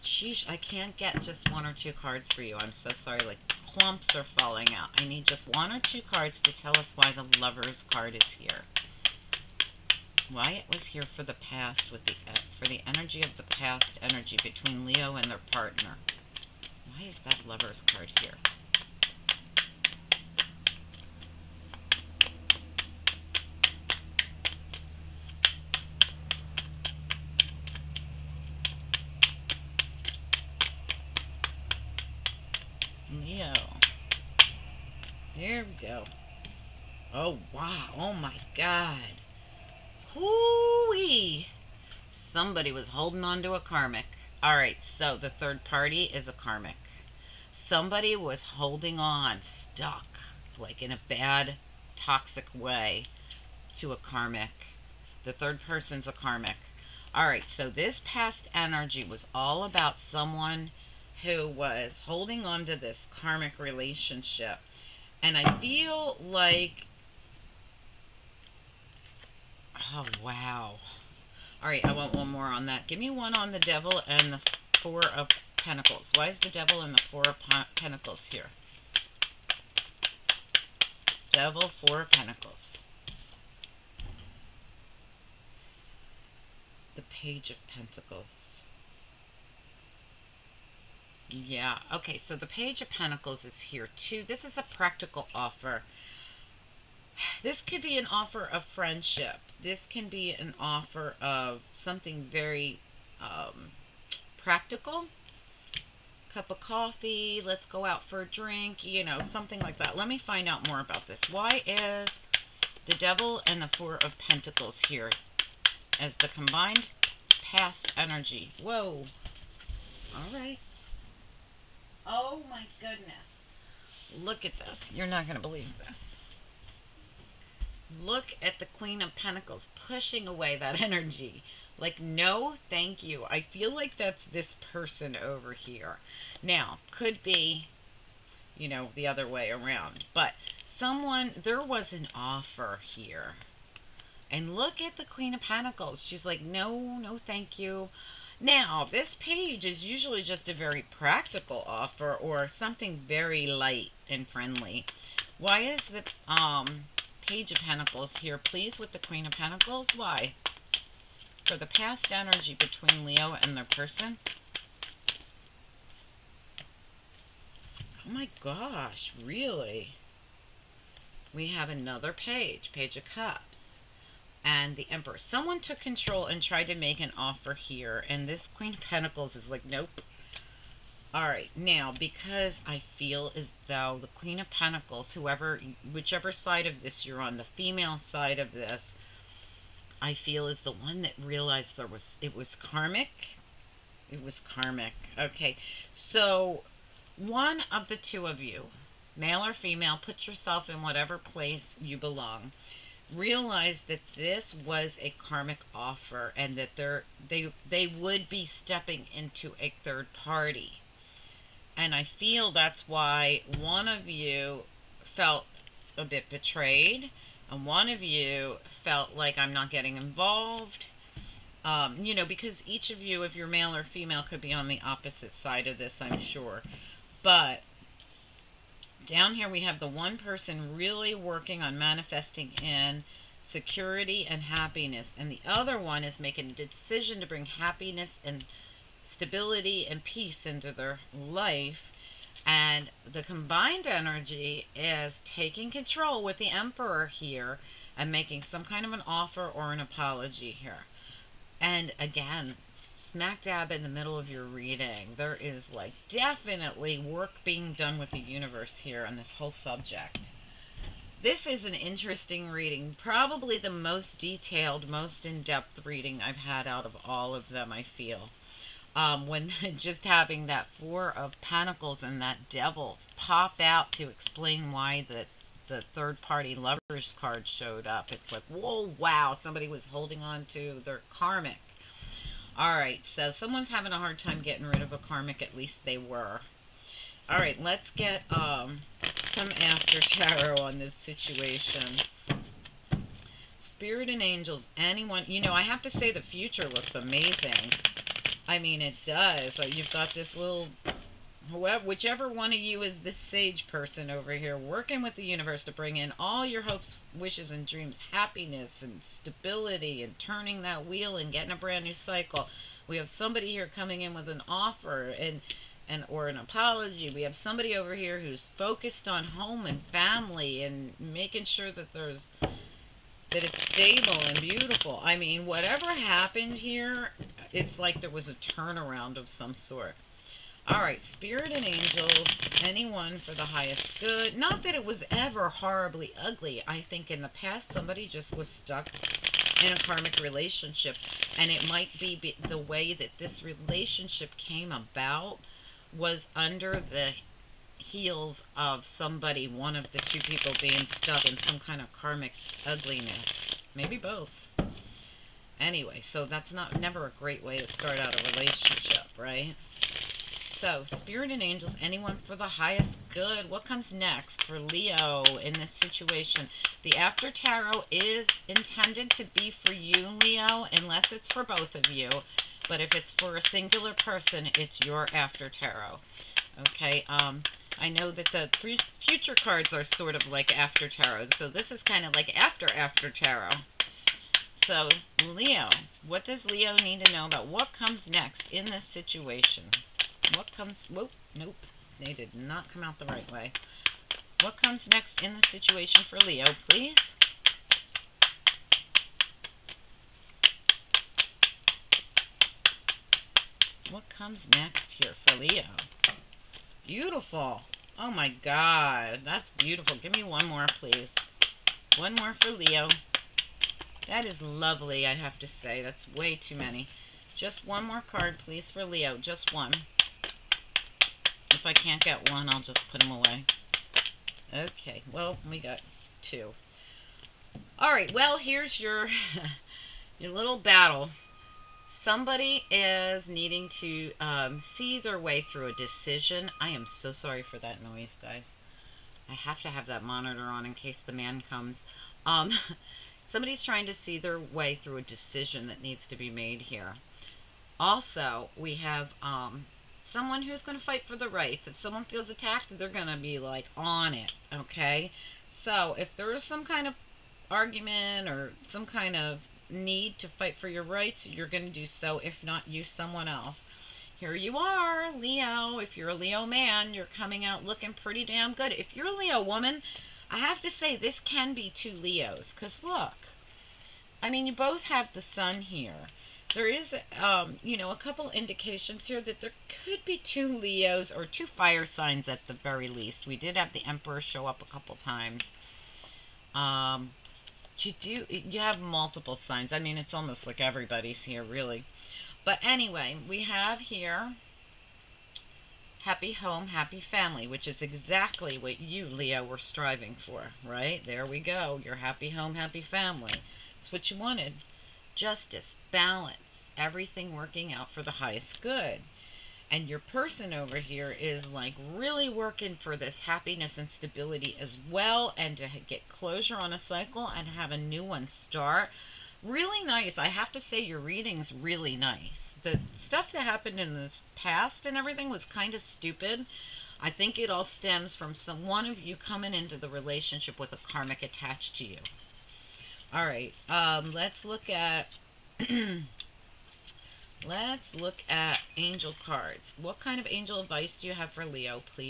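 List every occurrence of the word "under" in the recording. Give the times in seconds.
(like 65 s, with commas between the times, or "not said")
346 s.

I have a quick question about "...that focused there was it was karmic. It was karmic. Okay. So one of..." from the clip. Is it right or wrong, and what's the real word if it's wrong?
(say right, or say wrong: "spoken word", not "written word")
wrong: "realized", not "focused".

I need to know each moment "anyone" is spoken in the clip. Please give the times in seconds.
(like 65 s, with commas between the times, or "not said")
294 s, 332 s, 361 s.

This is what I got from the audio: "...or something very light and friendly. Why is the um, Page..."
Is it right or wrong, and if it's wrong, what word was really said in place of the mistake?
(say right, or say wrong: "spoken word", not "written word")
right.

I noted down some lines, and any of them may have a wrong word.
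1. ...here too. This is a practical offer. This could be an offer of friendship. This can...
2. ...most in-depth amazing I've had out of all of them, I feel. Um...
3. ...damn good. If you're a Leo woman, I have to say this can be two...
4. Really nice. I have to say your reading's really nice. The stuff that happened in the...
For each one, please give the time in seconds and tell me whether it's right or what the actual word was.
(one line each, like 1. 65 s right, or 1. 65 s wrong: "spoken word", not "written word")
1. 93 s right
2. 264 s wrong: "reading", not "amazing"
3. 468 s right
4. 519 s right.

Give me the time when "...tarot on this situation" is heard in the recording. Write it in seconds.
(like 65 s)
290 s.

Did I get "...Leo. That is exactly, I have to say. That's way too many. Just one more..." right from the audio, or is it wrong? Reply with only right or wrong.
wrong.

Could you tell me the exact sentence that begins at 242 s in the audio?
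And the combined energy is taking control with the emperor here I'm making some kind of an offer or an apology here.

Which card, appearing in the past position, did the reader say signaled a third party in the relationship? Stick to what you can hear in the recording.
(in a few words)
Lovers card.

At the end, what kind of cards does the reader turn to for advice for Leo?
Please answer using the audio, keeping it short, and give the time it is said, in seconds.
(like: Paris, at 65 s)
angel cards, at 538 s.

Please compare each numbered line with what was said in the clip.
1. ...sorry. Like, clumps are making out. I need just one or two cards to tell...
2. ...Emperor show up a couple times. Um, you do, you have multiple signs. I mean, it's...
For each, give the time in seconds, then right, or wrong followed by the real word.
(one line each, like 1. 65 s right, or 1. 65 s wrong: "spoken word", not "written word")
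1. 2 s wrong: "falling", not "making"
2. 483 s right.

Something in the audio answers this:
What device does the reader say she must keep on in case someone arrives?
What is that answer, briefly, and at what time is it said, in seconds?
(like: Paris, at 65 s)
monitor, at 440 s.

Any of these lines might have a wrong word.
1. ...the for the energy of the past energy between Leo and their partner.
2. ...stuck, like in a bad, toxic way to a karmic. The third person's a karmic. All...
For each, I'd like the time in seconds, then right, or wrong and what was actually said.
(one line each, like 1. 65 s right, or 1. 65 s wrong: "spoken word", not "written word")
1. 12 s right
2. 49 s right.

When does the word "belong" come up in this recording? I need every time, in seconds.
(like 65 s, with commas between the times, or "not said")
201 s.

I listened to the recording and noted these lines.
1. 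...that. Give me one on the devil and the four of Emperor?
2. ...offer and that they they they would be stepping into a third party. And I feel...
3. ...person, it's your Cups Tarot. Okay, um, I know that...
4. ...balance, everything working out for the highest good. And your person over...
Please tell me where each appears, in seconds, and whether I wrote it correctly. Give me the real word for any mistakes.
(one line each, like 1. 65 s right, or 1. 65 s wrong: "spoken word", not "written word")
1. 72 s wrong: "Pentacles", not "Emperor"
2. 205 s right
3. 373 s wrong: "After", not "Cups"
4. 505 s right.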